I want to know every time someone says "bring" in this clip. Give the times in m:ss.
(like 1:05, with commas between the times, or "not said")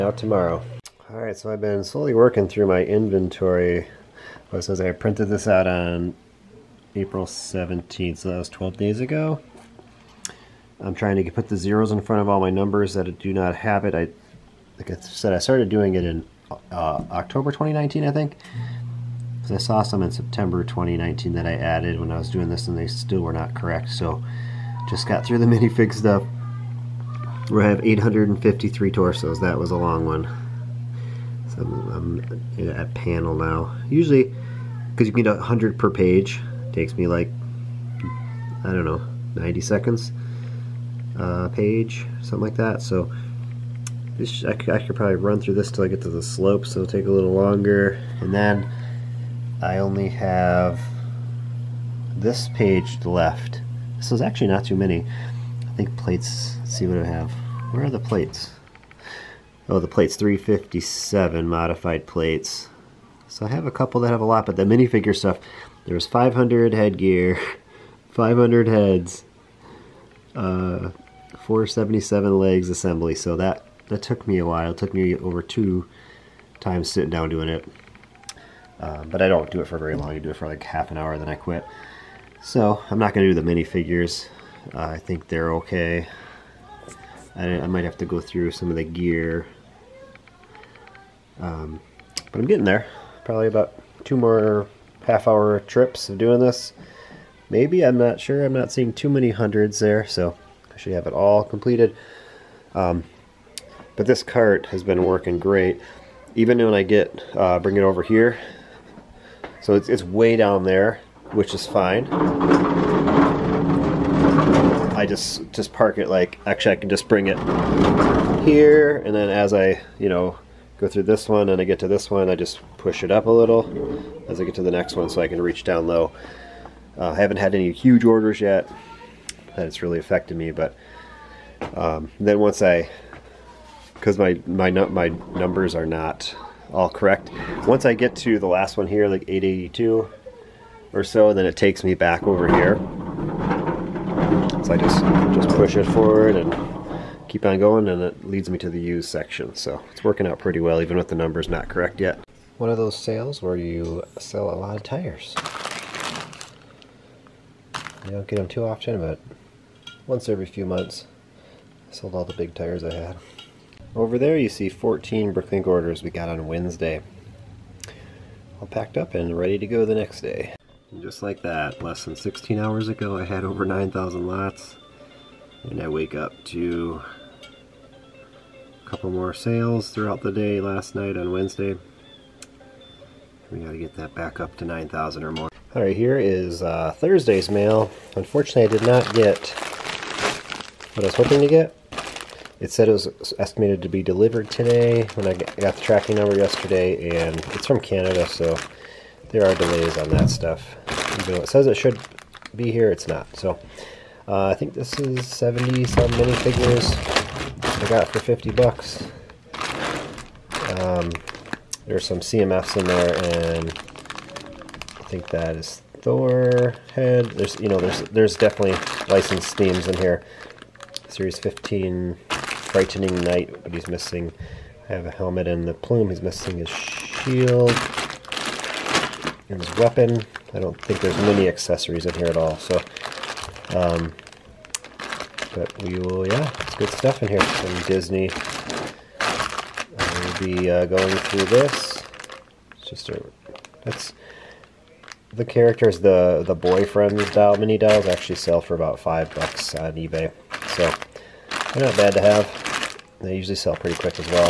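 1:47, 1:57.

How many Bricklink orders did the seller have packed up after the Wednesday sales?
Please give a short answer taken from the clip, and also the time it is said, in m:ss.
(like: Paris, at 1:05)
14, at 2:44.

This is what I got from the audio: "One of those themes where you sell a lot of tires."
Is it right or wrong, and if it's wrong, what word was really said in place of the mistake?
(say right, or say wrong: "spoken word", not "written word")
wrong: "sales", not "themes".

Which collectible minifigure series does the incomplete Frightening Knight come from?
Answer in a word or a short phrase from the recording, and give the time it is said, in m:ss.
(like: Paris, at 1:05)
Series 15, at 3:41.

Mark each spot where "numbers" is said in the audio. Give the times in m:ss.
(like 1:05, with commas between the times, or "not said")
0:12, 2:15, 2:31, 3:16.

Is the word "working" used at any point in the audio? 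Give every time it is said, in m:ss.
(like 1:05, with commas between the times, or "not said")
0:02, 1:45, 2:30.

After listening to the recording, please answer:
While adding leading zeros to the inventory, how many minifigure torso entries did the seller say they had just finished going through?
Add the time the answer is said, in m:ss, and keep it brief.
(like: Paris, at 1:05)
853, at 0:27.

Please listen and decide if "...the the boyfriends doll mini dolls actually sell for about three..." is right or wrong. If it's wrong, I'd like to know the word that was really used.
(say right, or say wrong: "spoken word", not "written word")
wrong: "five", not "three".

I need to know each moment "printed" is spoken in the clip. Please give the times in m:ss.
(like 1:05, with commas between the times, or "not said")
0:04.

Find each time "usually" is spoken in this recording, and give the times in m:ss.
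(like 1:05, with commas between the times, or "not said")
0:33, 4:13.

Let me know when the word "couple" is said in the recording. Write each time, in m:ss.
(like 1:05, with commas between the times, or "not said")
1:03, 2:58.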